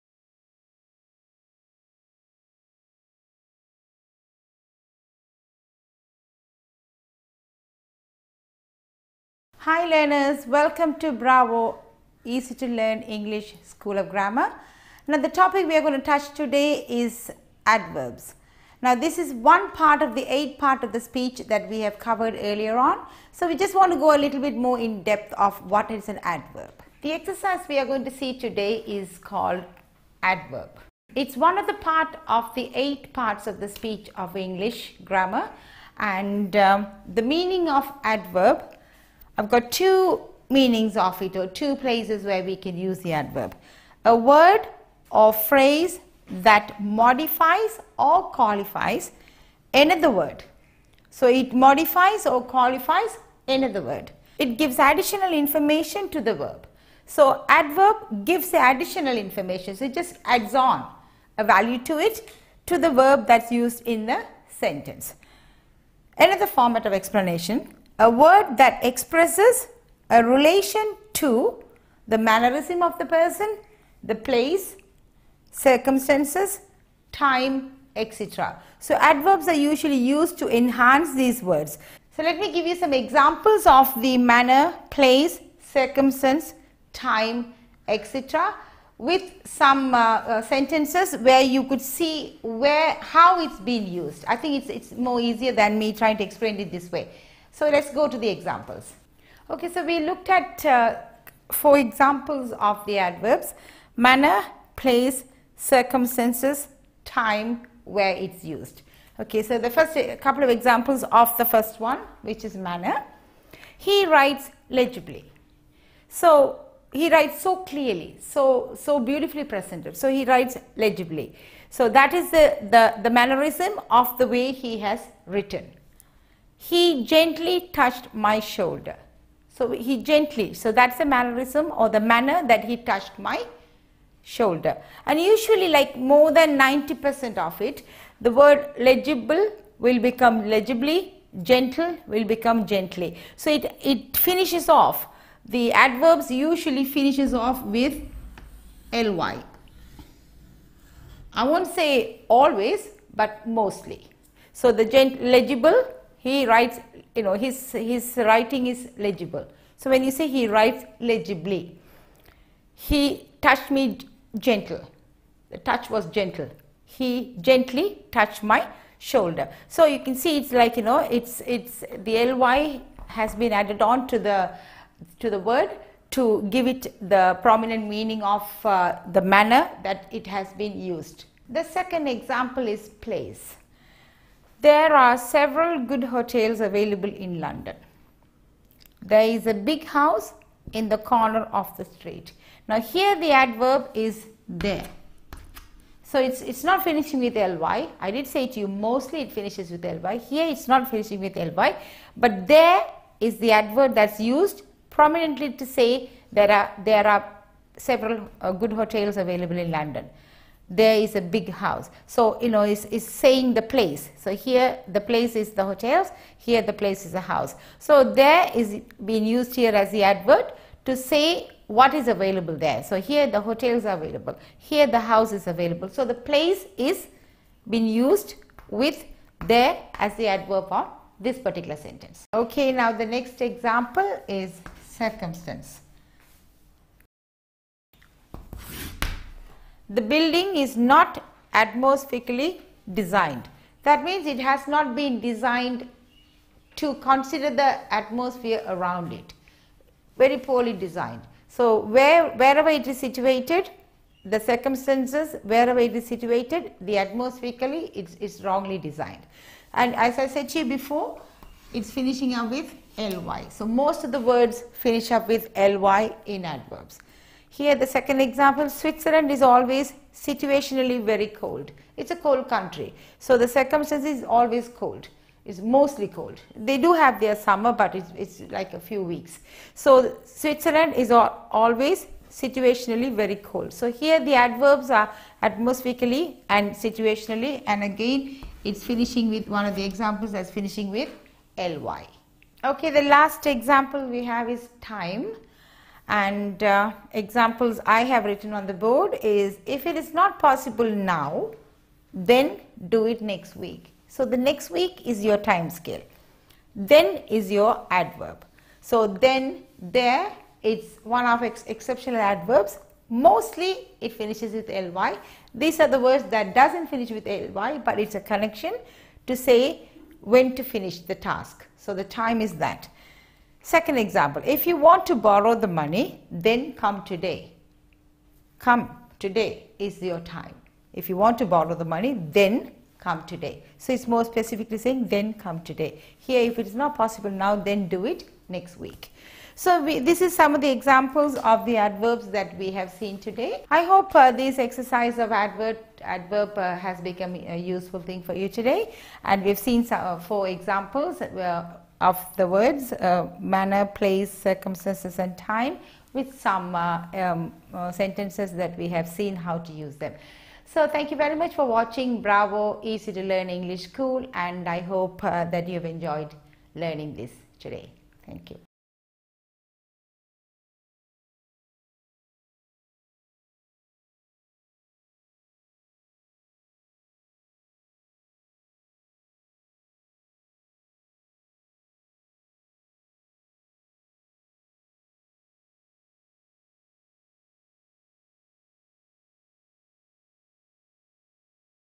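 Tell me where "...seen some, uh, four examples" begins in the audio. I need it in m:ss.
5:49.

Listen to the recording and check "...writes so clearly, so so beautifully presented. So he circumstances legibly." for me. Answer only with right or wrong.
wrong.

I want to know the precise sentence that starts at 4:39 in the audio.
So Switzerland is always situationally very cold.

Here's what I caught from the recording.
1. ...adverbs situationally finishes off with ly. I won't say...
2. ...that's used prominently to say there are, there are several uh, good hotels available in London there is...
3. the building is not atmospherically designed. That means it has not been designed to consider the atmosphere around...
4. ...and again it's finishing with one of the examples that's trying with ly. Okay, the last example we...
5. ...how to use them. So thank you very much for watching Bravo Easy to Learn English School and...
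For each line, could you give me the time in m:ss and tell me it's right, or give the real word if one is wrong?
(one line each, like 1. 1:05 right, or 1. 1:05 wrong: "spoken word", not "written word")
1. 2:25 wrong: "usually", not "situationally"
2. 3:23 right
3. 3:59 right
4. 4:47 wrong: "finishing", not "trying"
5. 5:59 right.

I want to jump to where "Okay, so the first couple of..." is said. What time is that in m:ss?
1:49.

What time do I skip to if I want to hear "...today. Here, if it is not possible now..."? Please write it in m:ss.
5:35.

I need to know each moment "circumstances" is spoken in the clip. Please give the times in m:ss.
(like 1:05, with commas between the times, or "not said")
1:15, 1:25, 1:45, 3:54, 4:14, 4:33, 5:54.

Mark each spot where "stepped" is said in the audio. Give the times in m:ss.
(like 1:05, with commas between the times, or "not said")
not said.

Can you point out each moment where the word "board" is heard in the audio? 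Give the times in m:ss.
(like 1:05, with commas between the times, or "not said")
4:58.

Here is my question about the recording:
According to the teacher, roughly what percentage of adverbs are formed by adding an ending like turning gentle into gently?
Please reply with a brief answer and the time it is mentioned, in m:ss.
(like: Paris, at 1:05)
90%, at 2:16.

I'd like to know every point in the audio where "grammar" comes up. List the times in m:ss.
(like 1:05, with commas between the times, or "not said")
0:14, 0:35.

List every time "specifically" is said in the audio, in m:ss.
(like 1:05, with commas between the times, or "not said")
5:34.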